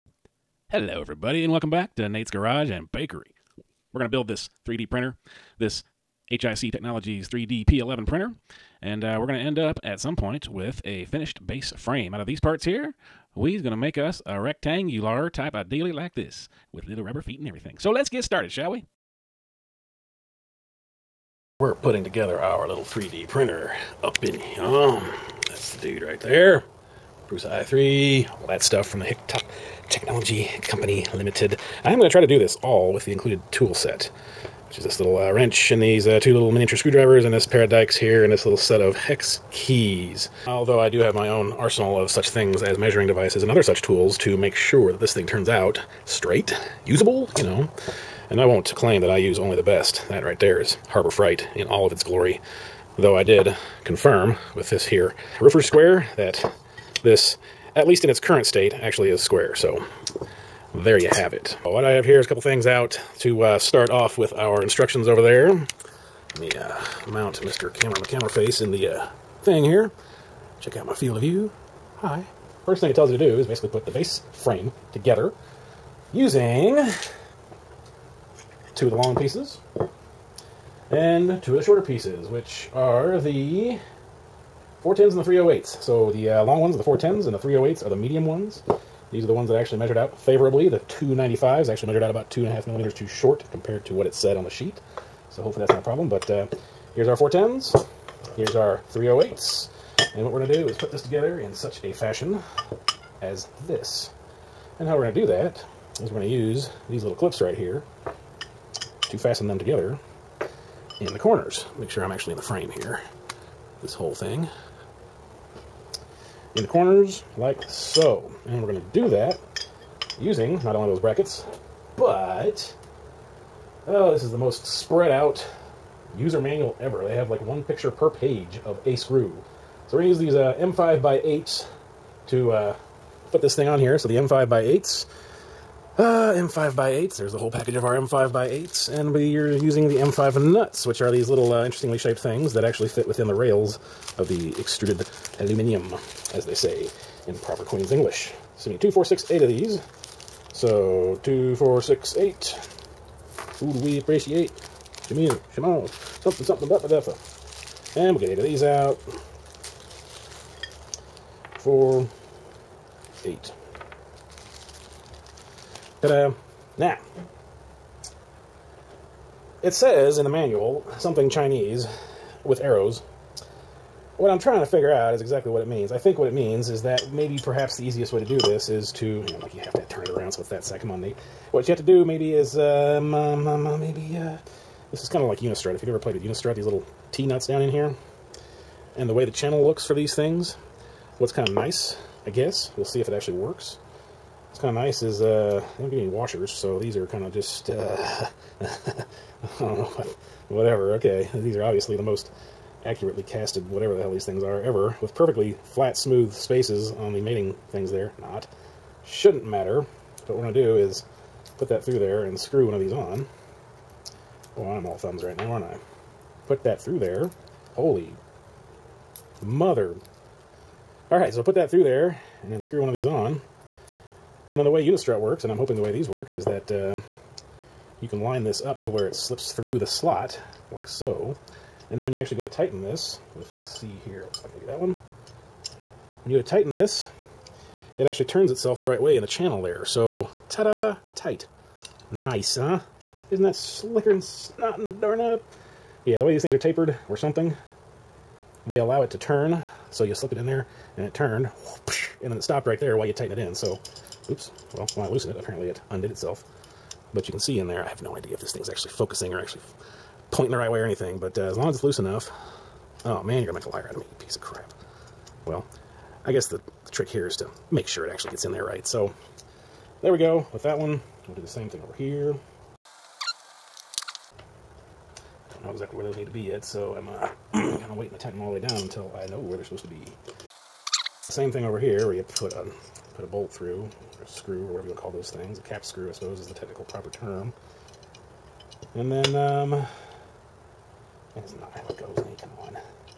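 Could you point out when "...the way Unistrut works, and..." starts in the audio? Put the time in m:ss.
3:44.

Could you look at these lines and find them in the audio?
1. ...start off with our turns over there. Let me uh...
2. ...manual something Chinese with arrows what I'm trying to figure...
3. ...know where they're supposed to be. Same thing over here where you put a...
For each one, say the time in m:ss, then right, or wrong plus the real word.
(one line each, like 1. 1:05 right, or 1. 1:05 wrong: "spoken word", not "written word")
1. 1:03 wrong: "instructions", not "turns"
2. 2:50 right
3. 4:39 right.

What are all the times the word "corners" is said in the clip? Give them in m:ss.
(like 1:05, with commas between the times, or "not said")
1:51, 1:56.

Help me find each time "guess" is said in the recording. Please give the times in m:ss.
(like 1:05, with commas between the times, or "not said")
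3:12, 4:26.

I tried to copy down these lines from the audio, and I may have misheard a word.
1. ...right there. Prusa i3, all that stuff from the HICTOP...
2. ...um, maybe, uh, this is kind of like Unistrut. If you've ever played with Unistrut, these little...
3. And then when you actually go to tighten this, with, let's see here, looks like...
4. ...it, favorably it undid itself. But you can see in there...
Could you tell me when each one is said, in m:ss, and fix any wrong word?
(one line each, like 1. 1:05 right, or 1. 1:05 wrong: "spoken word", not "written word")
1. 0:26 right
2. 3:03 right
3. 3:51 right
4. 4:15 wrong: "apparently", not "favorably".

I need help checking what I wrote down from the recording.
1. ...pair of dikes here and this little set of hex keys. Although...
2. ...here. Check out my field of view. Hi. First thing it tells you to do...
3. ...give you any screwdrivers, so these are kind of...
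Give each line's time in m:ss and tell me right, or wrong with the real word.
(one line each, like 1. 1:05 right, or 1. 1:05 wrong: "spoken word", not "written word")
1. 0:37 right
2. 1:09 right
3. 3:15 wrong: "washers", not "screwdrivers".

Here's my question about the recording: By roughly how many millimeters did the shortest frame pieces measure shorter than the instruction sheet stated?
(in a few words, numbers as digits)
2.5.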